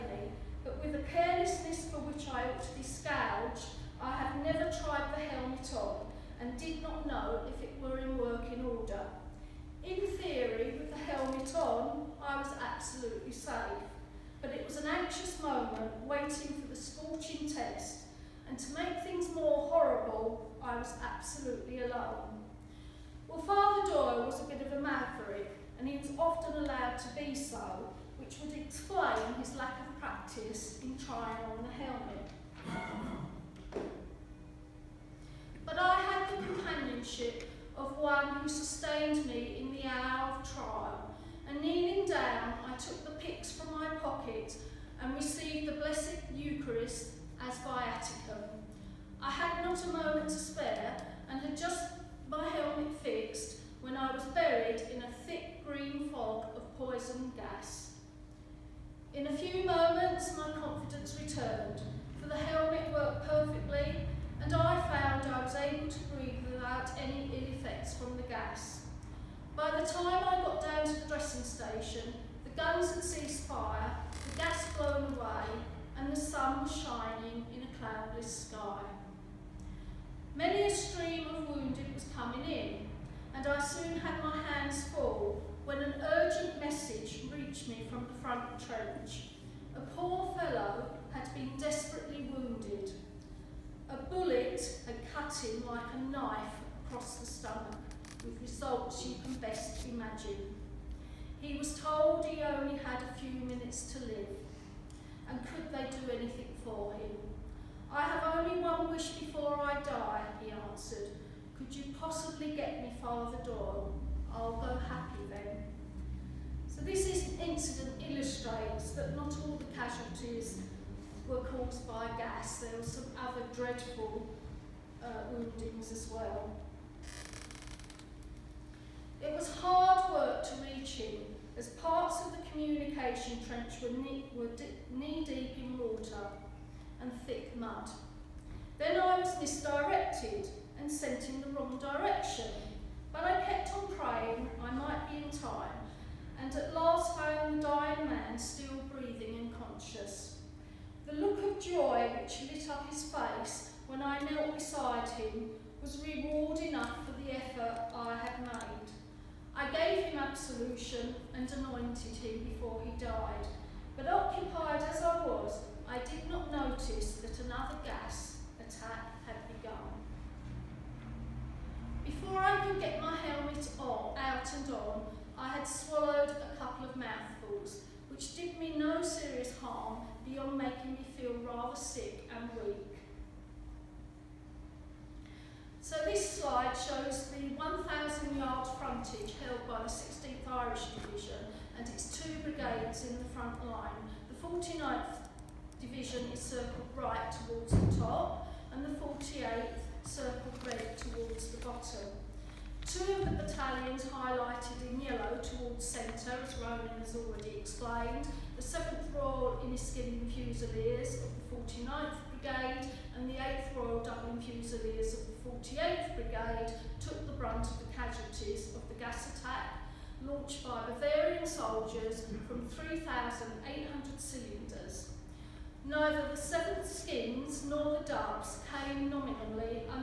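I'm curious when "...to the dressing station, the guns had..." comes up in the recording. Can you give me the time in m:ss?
1:10.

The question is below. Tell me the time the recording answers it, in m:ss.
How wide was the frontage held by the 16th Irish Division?
3:07.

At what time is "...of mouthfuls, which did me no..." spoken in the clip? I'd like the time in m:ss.
2:56.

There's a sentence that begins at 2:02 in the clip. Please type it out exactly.
There were some other dreadful uh, woundings as well.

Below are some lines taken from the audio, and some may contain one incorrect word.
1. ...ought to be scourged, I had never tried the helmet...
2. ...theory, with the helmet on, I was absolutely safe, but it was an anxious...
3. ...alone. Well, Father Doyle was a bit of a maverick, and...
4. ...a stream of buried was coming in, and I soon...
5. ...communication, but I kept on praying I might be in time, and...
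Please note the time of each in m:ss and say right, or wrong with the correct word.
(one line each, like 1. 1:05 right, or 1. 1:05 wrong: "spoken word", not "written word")
1. 0:02 right
2. 0:10 right
3. 0:21 right
4. 1:20 wrong: "wounded", not "buried"
5. 2:21 wrong: "direction", not "communication".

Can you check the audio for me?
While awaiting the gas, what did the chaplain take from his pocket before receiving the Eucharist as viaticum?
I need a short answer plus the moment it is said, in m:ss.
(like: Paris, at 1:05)
The pyx, at 0:43.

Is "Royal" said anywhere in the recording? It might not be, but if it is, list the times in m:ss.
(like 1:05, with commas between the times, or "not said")
3:29, 3:33.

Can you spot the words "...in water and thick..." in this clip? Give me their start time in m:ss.
2:15.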